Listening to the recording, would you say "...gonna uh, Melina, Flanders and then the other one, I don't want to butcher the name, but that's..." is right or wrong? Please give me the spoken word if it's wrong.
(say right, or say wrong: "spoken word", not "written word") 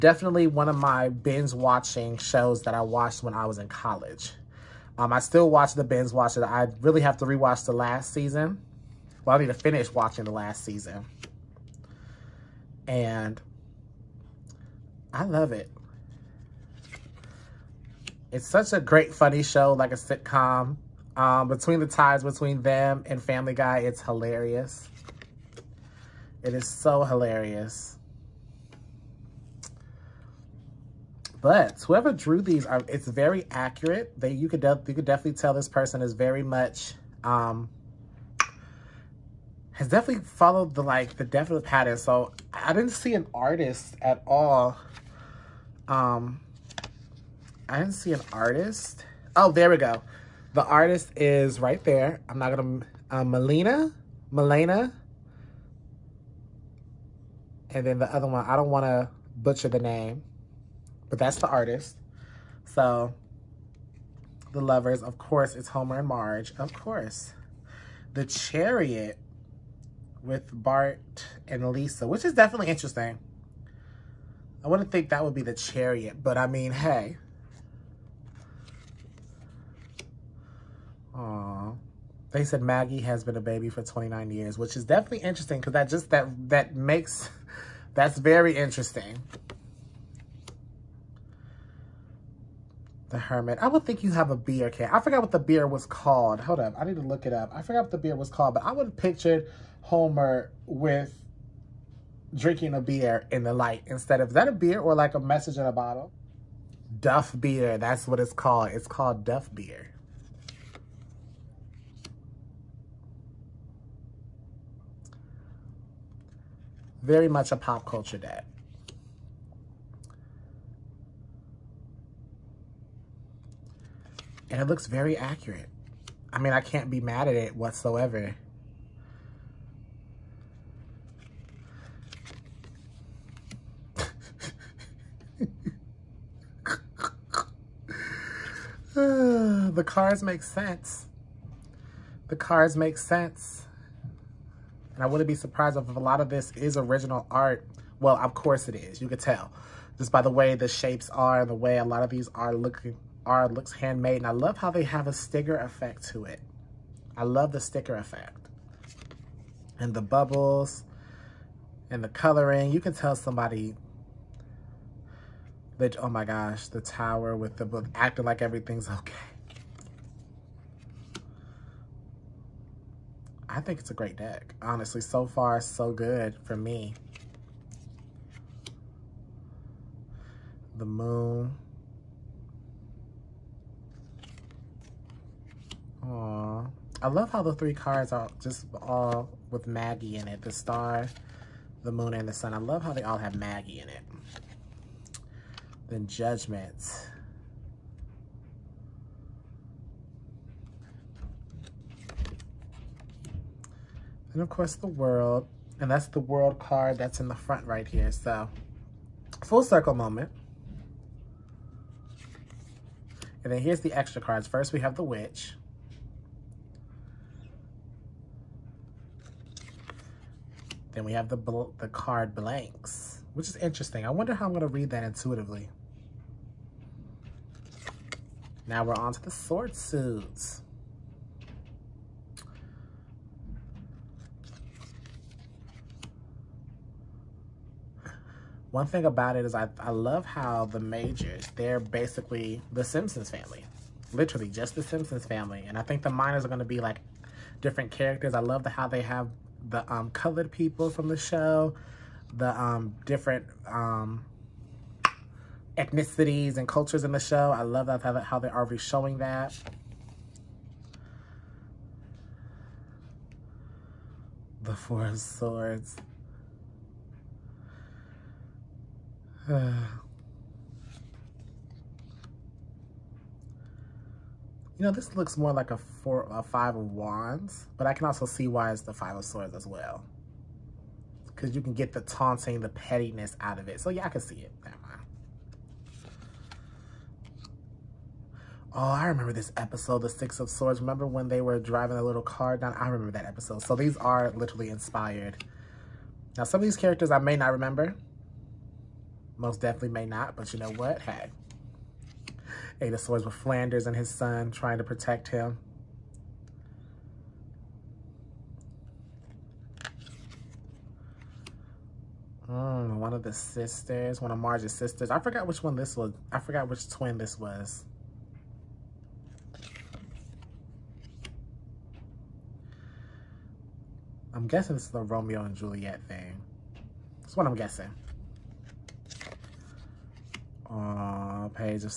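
wrong: "Melena", not "Flanders".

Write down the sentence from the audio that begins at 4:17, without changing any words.
I love that, how they're already showing that.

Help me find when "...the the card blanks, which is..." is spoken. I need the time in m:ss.
3:41.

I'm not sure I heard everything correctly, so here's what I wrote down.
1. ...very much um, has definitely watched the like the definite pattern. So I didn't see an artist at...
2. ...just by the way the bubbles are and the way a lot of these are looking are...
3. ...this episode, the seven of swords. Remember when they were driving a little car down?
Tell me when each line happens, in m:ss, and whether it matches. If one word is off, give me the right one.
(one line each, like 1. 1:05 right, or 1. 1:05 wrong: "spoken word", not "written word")
1. 0:36 wrong: "followed", not "watched"
2. 2:29 wrong: "shapes", not "bubbles"
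3. 4:49 wrong: "six", not "seven".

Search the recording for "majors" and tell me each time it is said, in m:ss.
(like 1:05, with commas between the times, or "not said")
4:00.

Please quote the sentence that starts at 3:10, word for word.
The star, the moon, and the sun.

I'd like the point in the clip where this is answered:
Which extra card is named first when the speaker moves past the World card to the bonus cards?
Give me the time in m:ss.
3:34.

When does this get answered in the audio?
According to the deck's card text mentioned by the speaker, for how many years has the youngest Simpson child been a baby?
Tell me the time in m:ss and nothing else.
1:23.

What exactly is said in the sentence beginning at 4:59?
Most definitely may not, but you know what?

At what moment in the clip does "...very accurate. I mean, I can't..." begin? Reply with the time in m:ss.
2:04.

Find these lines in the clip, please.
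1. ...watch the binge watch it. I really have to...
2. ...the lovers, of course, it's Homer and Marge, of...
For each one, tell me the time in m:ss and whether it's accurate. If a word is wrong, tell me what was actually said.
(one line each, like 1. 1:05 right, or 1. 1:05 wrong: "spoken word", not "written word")
1. 0:05 right
2. 1:04 right.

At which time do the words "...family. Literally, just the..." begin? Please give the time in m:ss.
4:03.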